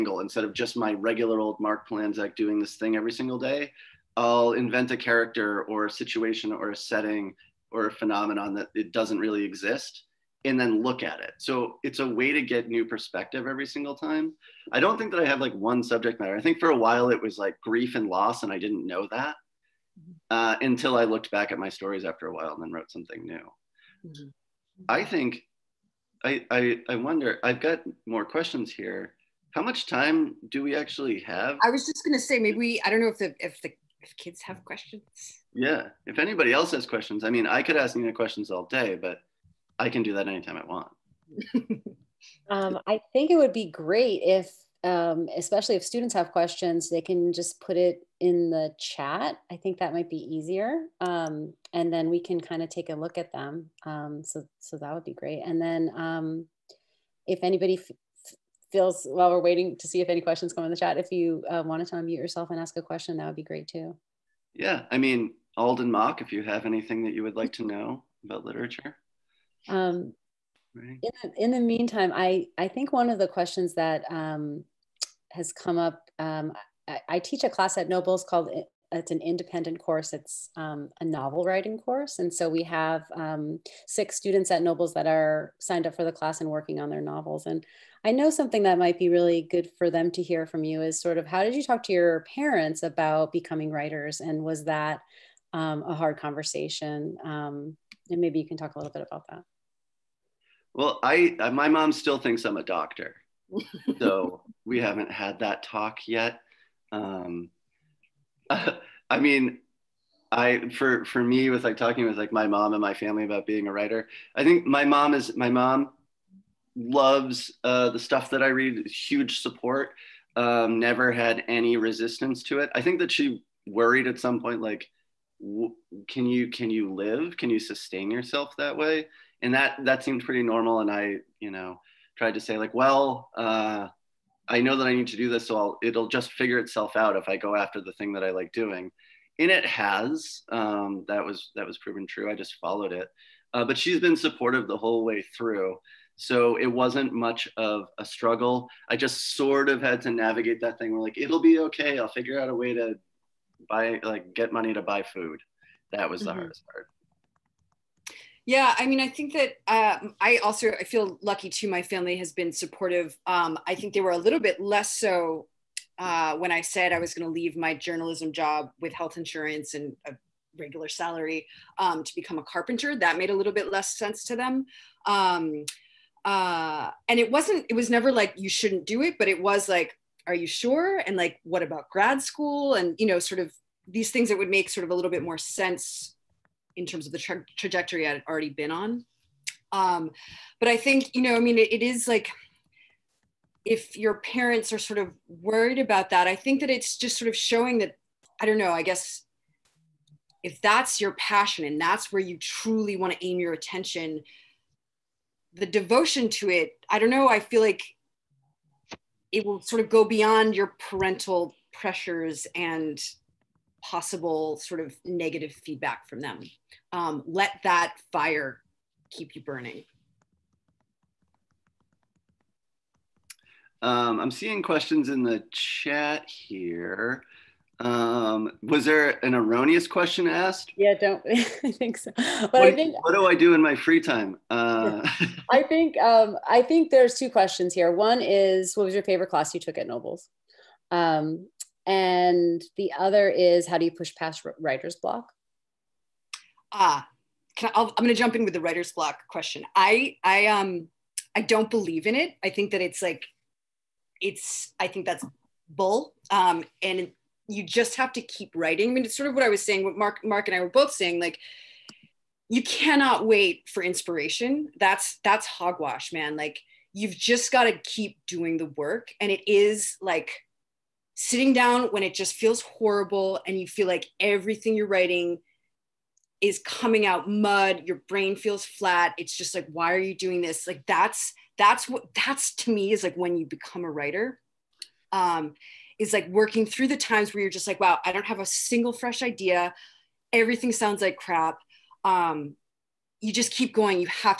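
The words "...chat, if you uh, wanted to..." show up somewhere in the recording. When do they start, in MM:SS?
01:00.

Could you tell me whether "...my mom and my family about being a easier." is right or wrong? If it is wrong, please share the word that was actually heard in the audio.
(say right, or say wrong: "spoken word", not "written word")
wrong: "writer", not "easier".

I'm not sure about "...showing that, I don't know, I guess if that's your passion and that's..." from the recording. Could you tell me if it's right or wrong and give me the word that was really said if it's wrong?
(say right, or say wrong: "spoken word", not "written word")
right.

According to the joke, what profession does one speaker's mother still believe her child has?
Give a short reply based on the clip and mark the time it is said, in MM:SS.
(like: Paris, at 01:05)
doctor, at 01:42.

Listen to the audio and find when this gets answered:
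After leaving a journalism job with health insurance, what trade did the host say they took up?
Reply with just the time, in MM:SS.
02:52.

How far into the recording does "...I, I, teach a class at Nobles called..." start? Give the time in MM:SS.
01:16.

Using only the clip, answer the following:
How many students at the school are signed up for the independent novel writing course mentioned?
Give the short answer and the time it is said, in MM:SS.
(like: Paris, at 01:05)
6, at 01:23.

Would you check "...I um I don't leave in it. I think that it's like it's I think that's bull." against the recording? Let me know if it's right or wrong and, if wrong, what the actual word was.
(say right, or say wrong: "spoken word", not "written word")
wrong: "believe", not "leave".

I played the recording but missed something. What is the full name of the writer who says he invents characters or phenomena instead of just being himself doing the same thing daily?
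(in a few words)
Mark Polanzak.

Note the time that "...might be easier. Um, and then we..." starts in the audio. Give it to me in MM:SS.
00:49.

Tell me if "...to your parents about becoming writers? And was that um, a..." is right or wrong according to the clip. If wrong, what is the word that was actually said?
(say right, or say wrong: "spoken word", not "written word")
right.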